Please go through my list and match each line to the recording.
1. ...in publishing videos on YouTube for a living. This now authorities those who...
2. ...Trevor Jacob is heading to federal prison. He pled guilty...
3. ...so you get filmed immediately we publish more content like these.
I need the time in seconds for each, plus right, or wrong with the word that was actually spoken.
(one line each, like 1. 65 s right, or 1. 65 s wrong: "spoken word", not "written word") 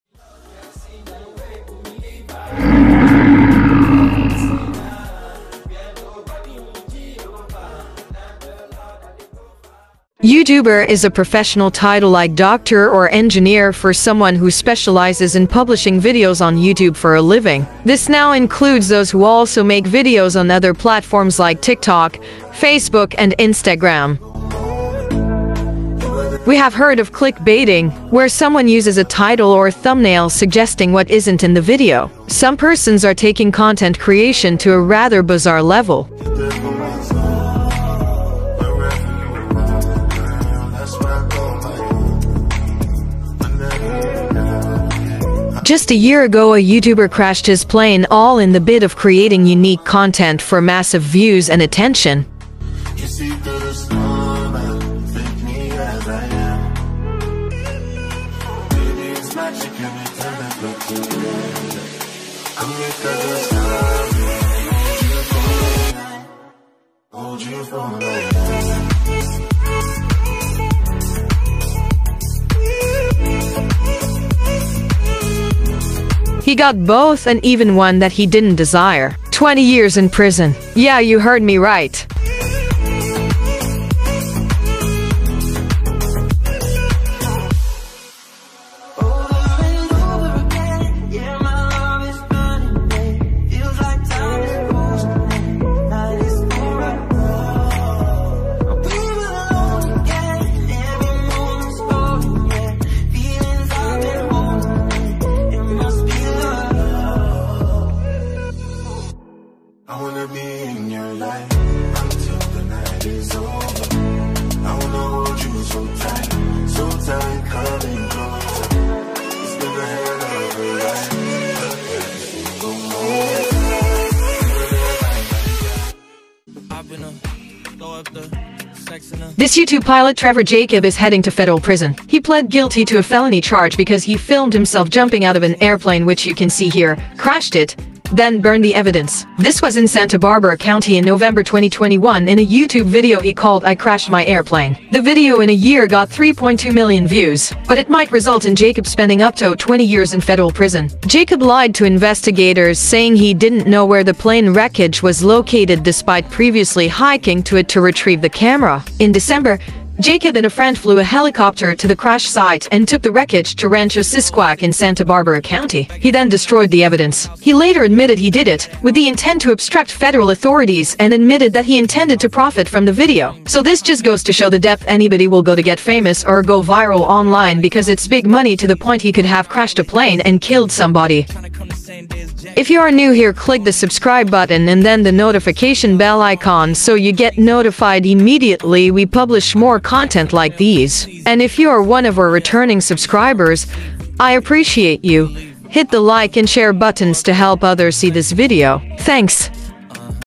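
1. 15 s wrong: "includes", not "authorities"
2. 130 s right
3. 186 s wrong: "notified", not "filmed".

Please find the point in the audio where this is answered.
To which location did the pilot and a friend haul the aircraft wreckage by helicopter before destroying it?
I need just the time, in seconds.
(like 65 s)
163 s.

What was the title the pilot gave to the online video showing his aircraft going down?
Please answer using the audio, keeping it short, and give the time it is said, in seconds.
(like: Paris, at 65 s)
I Crashed My Airplane, at 143 s.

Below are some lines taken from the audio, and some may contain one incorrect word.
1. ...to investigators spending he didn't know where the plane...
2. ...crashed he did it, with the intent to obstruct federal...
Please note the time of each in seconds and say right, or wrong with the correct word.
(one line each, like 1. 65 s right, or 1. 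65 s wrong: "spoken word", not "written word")
1. 151 s wrong: "saying", not "spending"
2. 167 s wrong: "admitted", not "crashed".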